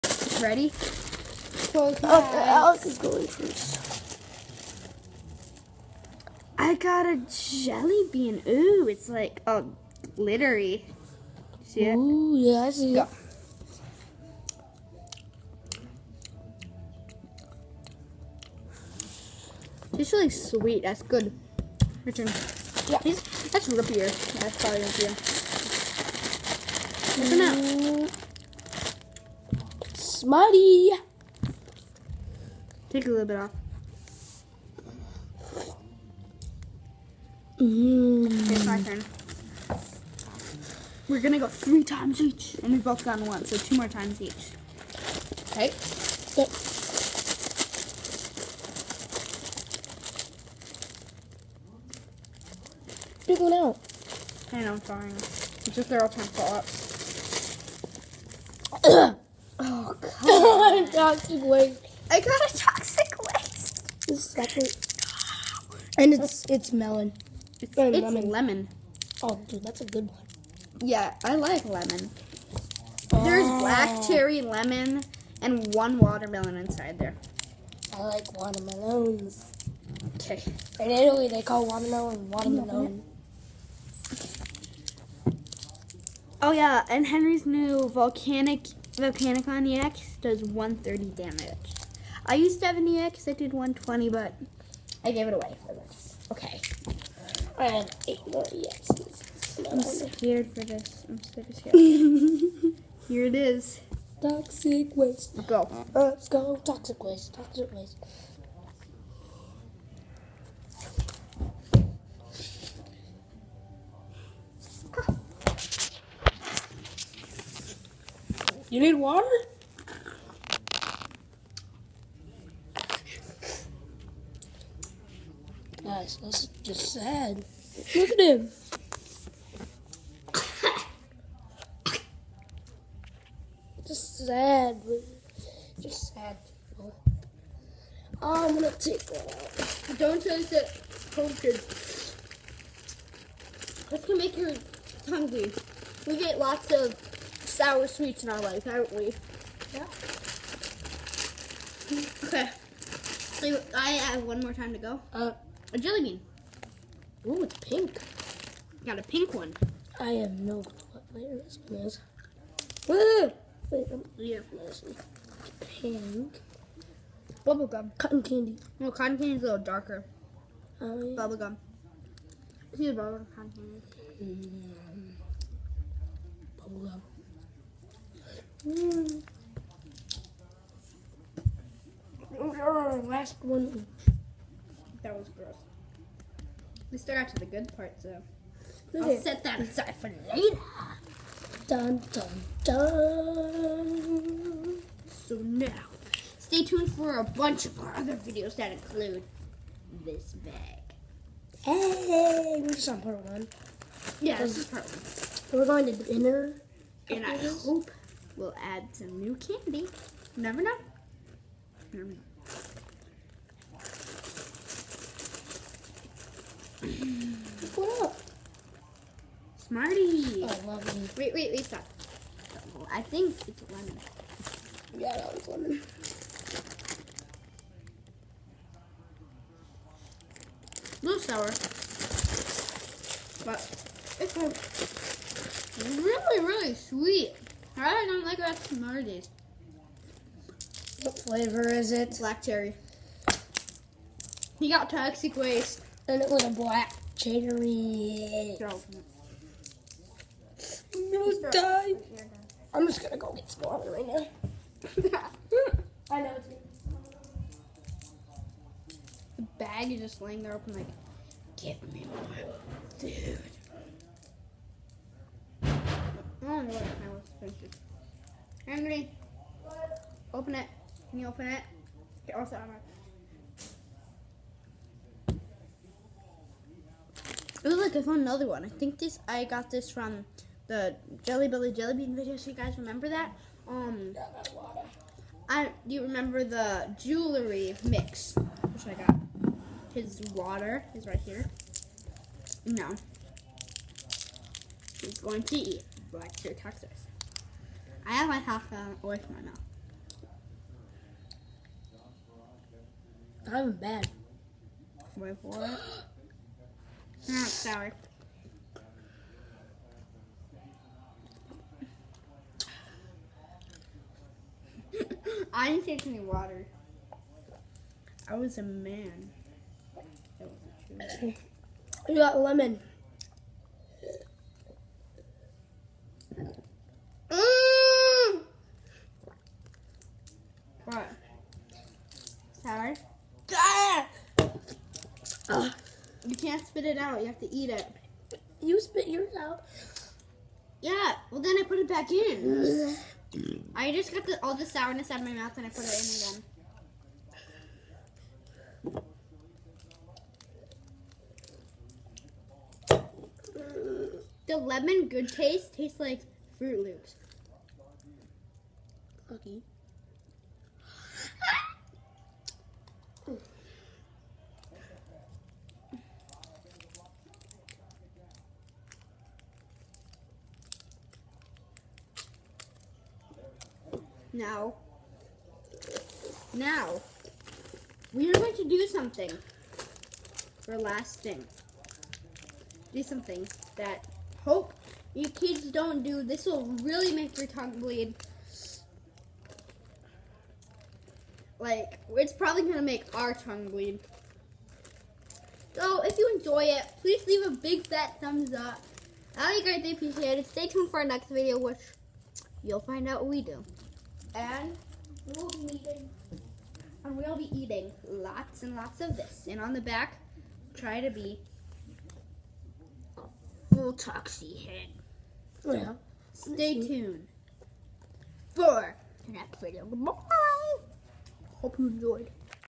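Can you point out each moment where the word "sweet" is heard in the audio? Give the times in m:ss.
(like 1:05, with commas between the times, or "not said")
0:20, 2:27, 3:56.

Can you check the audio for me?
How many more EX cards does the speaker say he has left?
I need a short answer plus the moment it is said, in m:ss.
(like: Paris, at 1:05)
8, at 1:38.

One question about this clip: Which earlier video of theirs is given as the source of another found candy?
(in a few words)
Jelly Belly Jelly Bean video.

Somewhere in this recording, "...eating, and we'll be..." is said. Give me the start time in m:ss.
6:45.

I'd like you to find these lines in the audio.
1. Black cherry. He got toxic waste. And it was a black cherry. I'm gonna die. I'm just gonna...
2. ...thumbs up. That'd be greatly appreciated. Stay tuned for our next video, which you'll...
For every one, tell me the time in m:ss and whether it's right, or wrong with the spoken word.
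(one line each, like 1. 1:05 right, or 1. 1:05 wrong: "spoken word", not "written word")
1. 4:02 right
2. 6:38 right.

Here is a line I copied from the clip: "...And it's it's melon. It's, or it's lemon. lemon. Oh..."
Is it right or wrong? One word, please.
right.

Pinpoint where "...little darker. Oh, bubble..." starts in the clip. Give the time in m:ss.
2:49.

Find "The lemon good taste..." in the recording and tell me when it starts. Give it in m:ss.
5:54.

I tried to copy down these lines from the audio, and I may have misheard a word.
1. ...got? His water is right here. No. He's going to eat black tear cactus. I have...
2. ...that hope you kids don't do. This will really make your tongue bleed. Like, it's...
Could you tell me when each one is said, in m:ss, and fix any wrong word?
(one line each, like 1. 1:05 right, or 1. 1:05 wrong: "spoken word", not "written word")
1. 4:49 right
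2. 6:23 right.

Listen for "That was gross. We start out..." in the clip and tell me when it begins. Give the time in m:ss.
3:05.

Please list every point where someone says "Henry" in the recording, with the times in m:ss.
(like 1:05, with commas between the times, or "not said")
1:27, 4:28.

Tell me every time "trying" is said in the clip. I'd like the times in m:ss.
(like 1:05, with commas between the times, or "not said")
0:56.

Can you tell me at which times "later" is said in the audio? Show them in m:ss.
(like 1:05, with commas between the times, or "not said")
3:10.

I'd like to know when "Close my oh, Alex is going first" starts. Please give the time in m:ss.
0:00.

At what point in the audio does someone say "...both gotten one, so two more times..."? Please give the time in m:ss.
0:42.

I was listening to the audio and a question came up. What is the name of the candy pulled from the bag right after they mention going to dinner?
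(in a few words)
Smarty.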